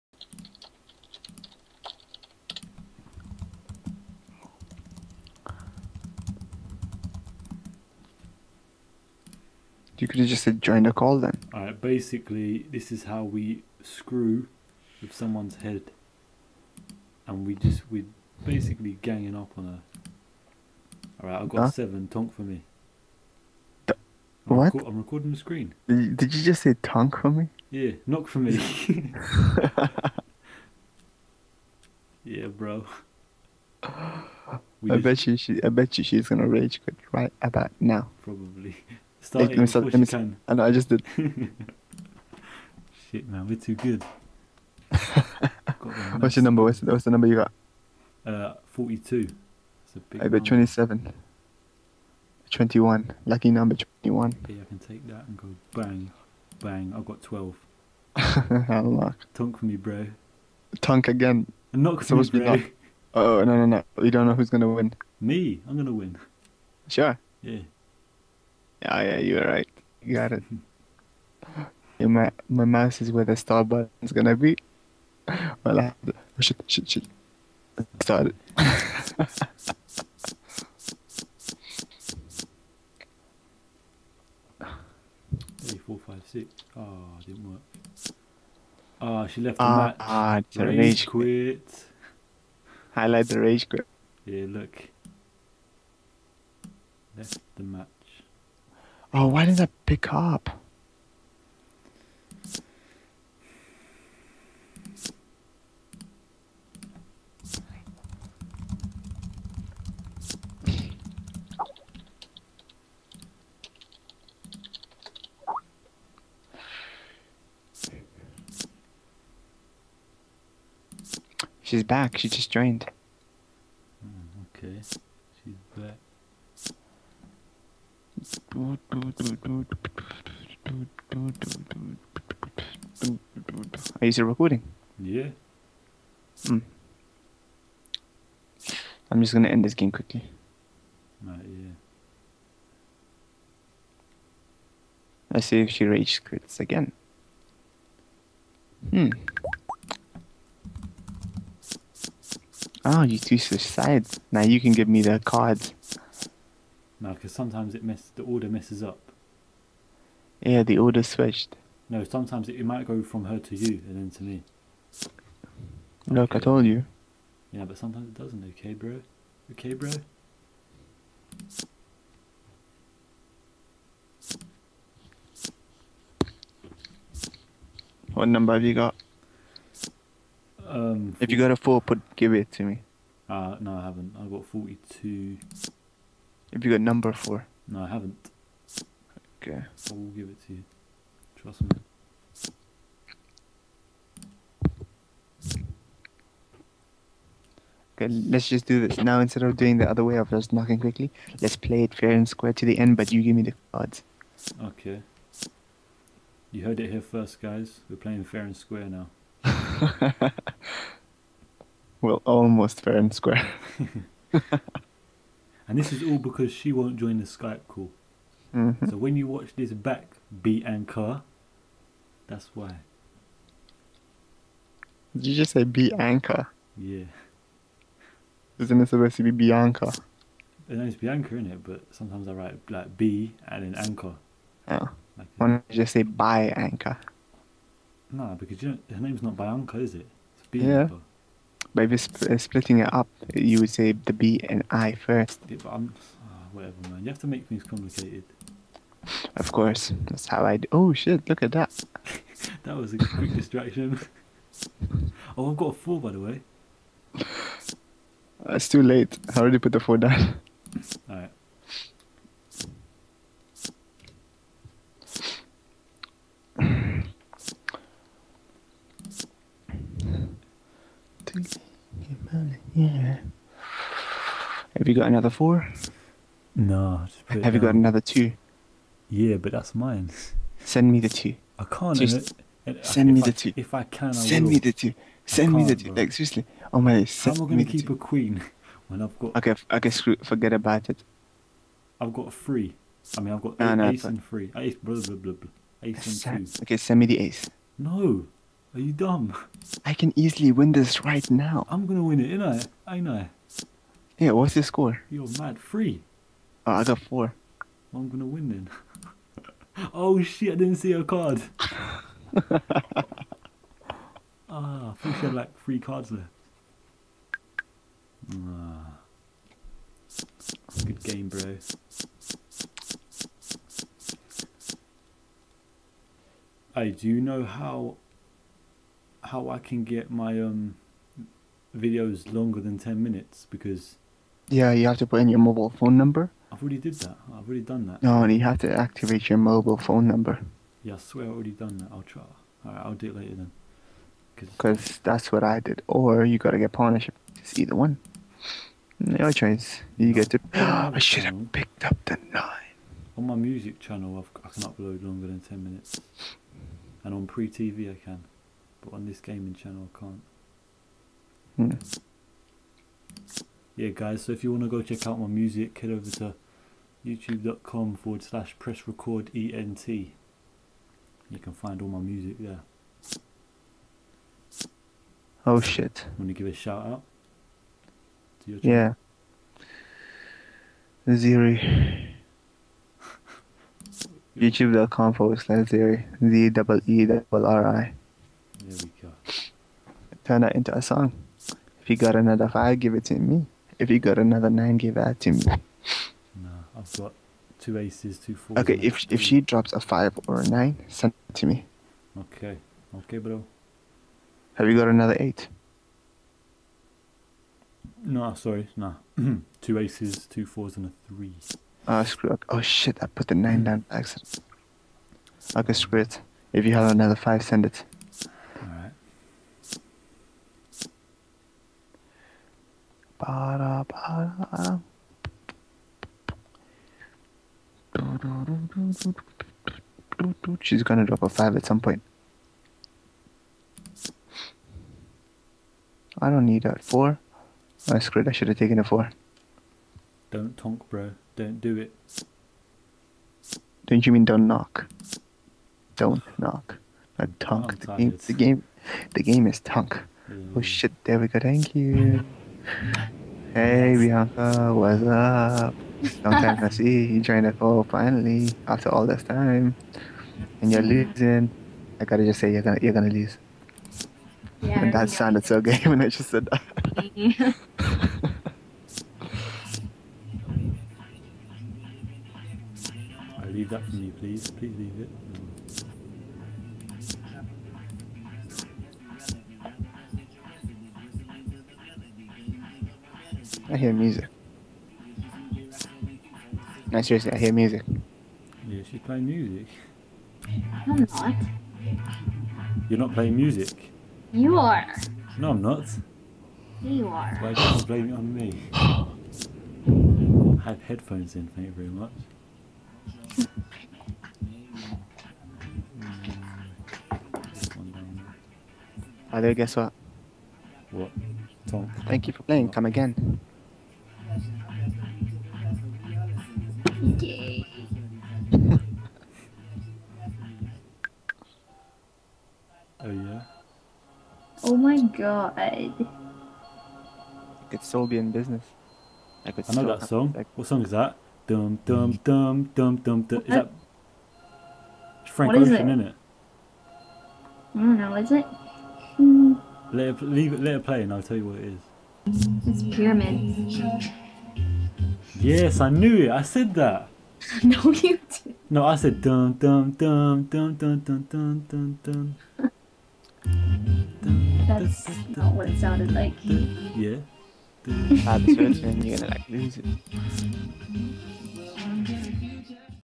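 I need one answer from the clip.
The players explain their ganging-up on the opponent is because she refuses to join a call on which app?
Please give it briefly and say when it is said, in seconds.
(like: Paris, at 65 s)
Skype, at 217 s.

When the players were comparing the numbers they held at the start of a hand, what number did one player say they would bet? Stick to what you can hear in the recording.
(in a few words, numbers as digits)
27.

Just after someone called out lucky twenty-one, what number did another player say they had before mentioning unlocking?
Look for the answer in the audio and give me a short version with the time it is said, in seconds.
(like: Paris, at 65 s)
12, at 57 s.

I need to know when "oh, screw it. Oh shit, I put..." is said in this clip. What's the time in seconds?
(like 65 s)
411 s.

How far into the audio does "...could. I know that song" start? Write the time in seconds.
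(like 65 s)
529 s.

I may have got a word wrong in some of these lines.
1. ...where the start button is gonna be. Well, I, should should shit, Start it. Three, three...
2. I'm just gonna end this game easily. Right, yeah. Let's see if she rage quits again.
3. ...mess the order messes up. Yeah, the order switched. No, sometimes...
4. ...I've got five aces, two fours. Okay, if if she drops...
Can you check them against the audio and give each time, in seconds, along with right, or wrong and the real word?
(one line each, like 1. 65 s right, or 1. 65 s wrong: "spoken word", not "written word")
1. 73 s wrong: "four", not "three"
2. 139 s wrong: "quickly", not "easily"
3. 157 s right
4. 396 s wrong: "two", not "five".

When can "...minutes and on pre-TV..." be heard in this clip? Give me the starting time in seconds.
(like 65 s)
355 s.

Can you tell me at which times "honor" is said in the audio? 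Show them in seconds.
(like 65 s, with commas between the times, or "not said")
not said.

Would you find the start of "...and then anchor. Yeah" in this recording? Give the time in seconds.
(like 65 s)
233 s.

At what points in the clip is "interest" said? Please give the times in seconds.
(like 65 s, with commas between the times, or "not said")
not said.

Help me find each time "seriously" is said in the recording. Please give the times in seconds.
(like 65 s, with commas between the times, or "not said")
286 s, 487 s.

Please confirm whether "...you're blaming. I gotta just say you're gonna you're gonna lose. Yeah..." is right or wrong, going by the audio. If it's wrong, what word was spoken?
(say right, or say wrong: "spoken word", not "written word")
wrong: "losing", not "blaming".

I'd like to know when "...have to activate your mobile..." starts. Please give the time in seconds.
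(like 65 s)
338 s.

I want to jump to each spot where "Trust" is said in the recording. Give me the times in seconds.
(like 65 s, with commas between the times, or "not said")
191 s.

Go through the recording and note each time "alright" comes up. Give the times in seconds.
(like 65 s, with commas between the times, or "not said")
11 s, 21 s, 261 s, 342 s.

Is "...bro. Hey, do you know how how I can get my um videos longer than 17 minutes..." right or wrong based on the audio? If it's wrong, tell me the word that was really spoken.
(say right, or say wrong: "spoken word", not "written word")
wrong: "10", not "17".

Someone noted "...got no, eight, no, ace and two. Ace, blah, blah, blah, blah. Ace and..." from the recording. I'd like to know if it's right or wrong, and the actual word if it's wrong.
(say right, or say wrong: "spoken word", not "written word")
wrong: "three", not "two".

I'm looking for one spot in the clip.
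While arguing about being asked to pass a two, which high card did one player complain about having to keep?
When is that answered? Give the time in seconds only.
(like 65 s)
287 s.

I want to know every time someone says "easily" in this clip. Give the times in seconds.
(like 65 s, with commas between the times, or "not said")
300 s.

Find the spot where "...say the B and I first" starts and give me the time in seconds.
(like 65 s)
243 s.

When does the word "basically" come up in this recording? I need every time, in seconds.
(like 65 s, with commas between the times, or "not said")
11 s, 18 s.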